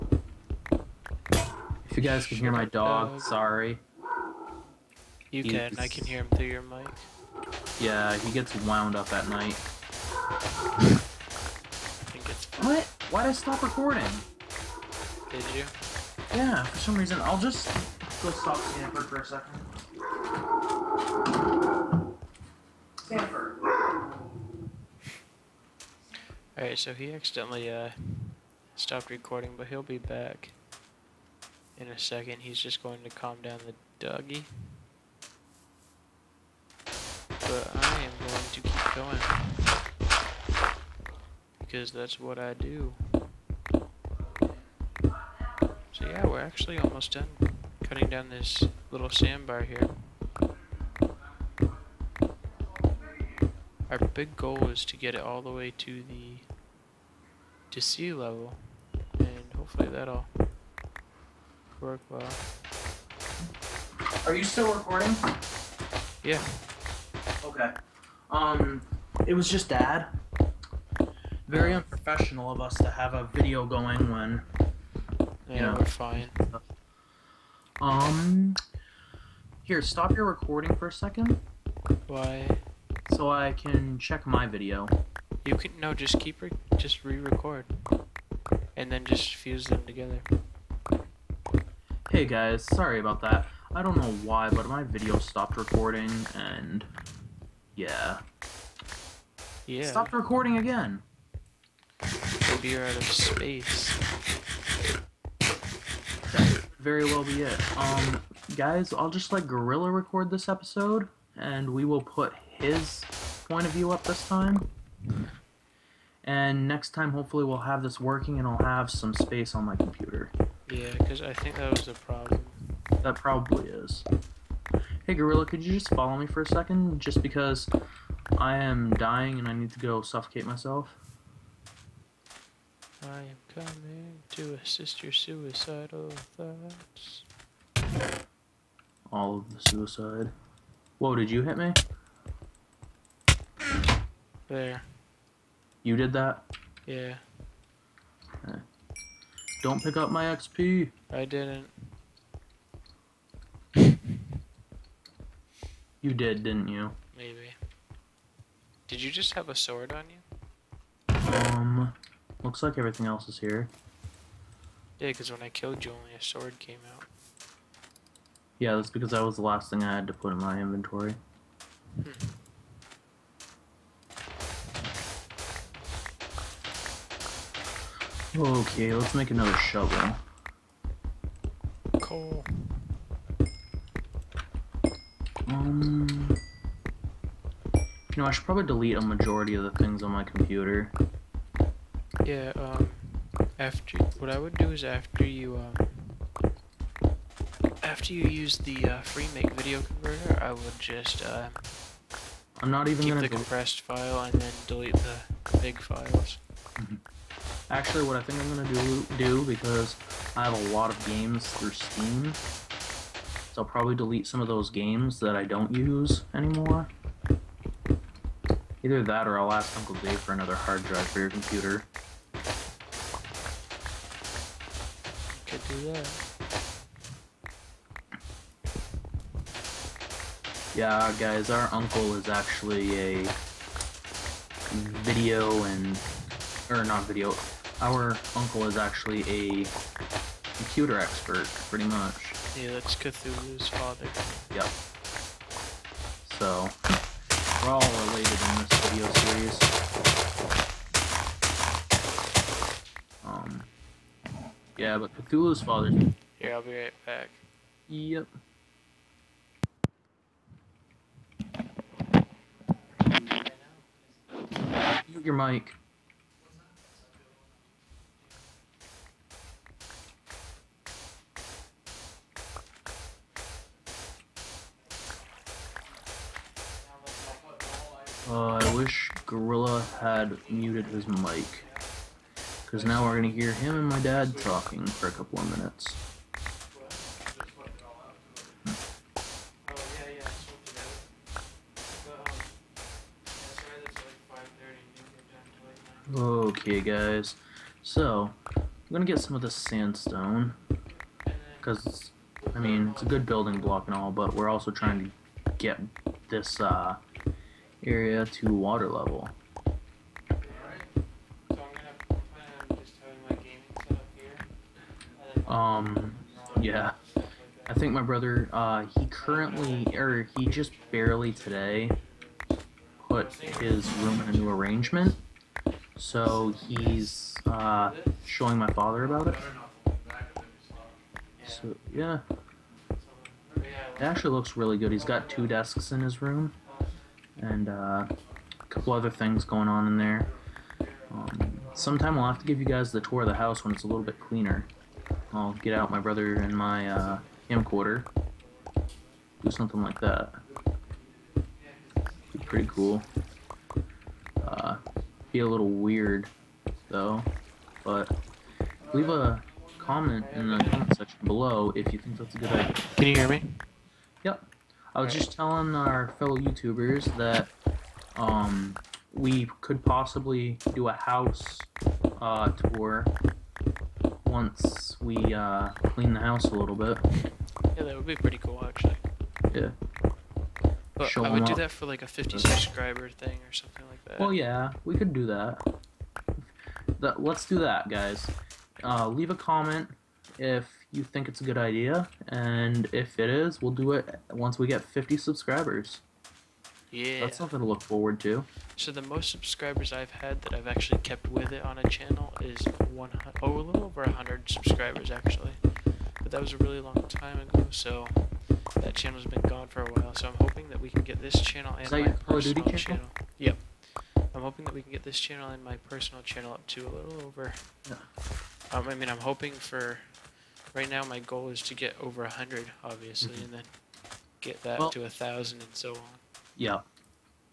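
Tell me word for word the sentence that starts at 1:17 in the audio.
Um, here, stop your recording for a second.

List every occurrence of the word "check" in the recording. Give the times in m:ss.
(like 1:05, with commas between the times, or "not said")
1:23.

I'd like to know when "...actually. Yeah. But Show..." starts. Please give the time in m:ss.
6:18.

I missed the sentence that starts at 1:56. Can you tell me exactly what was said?
And next time, hopefully, we'll have this working, and I'll have some space on my computer.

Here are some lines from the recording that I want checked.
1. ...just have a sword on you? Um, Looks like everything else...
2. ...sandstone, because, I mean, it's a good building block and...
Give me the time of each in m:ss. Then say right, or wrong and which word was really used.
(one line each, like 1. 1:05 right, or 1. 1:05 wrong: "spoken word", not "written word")
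1. 2:39 right
2. 4:59 right.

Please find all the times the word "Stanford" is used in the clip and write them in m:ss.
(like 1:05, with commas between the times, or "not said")
0:18, 0:23.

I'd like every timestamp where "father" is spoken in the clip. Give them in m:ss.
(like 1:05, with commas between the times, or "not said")
4:03, 4:15, 5:28.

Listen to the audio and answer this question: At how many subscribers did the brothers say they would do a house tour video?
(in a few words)
50.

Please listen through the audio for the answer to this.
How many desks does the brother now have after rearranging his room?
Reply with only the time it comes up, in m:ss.
5:35.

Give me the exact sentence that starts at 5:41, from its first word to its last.
Um, sometime we'll have to give you guys the tour of the house when it's a little bit cleaner.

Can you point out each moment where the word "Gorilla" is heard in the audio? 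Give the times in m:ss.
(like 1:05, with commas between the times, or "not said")
1:49, 2:05, 4:39.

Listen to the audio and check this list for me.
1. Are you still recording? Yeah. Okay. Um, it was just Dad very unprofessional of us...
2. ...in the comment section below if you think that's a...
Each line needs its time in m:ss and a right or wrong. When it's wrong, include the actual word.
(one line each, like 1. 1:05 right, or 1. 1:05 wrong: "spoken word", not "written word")
1. 1:04 right
2. 6:00 right.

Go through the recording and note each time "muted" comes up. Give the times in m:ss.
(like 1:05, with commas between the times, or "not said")
4:40.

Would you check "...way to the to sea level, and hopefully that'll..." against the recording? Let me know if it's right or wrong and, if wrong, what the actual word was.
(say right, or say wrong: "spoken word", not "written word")
right.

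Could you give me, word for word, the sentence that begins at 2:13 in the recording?
I am coming to assist your suicidal thoughts.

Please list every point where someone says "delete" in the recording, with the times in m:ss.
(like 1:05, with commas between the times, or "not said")
3:08, 3:24, 3:33.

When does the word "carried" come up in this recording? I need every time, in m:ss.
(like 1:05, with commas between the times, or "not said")
not said.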